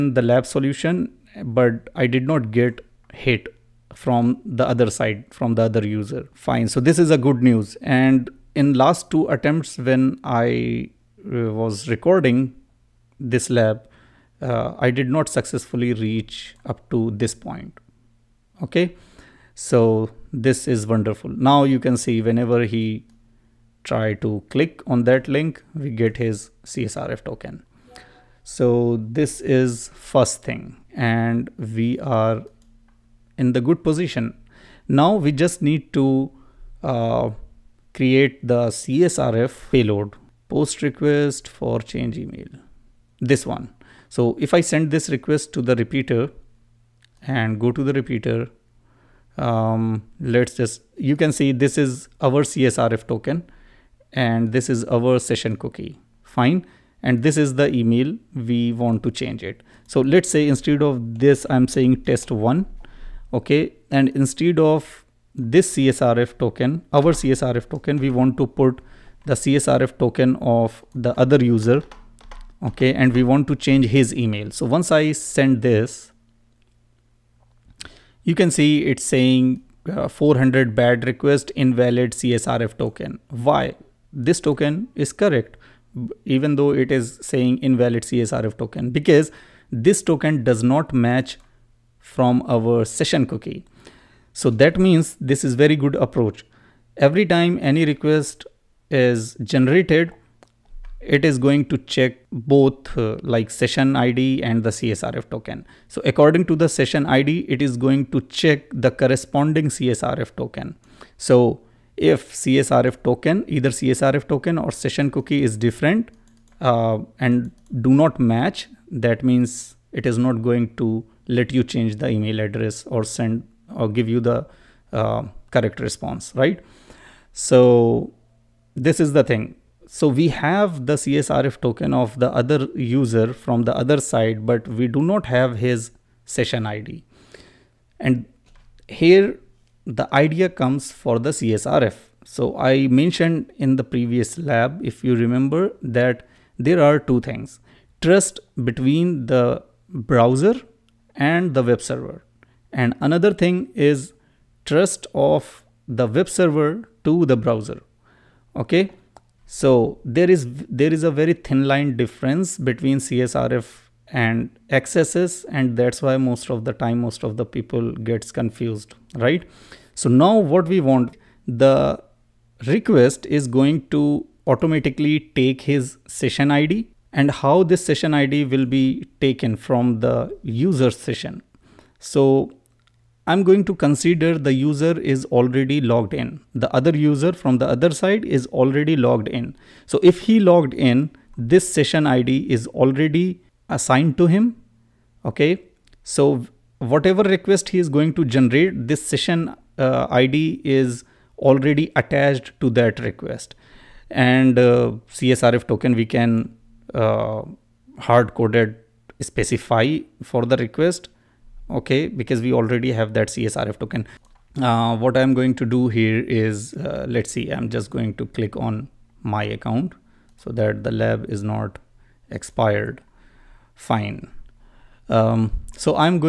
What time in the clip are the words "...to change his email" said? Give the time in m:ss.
1:13.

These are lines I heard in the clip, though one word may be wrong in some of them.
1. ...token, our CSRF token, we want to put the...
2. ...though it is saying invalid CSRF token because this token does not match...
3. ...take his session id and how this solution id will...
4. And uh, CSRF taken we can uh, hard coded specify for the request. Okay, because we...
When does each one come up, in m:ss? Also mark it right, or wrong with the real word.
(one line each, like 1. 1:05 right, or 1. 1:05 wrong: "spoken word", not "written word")
1. 1:06 right
2. 1:26 right
3. 2:55 wrong: "session", not "solution"
4. 3:24 wrong: "token", not "taken".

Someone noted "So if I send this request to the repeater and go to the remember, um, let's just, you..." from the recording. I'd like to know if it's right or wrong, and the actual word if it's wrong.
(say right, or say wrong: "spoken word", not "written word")
wrong: "repeater", not "remember".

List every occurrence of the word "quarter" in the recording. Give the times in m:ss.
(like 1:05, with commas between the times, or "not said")
not said.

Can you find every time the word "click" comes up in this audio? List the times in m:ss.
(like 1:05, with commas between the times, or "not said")
0:24, 3:38.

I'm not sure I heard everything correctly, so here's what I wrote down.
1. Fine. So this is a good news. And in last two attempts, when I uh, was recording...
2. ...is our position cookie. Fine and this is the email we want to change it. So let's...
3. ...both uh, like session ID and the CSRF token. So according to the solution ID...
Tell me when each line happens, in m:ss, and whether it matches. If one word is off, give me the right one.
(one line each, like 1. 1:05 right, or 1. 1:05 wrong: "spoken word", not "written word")
1. 0:06 right
2. 0:54 wrong: "session", not "position"
3. 1:42 wrong: "session", not "solution".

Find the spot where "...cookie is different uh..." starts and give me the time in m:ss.
1:55.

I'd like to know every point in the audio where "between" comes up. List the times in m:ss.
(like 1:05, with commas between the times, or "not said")
2:28, 2:42.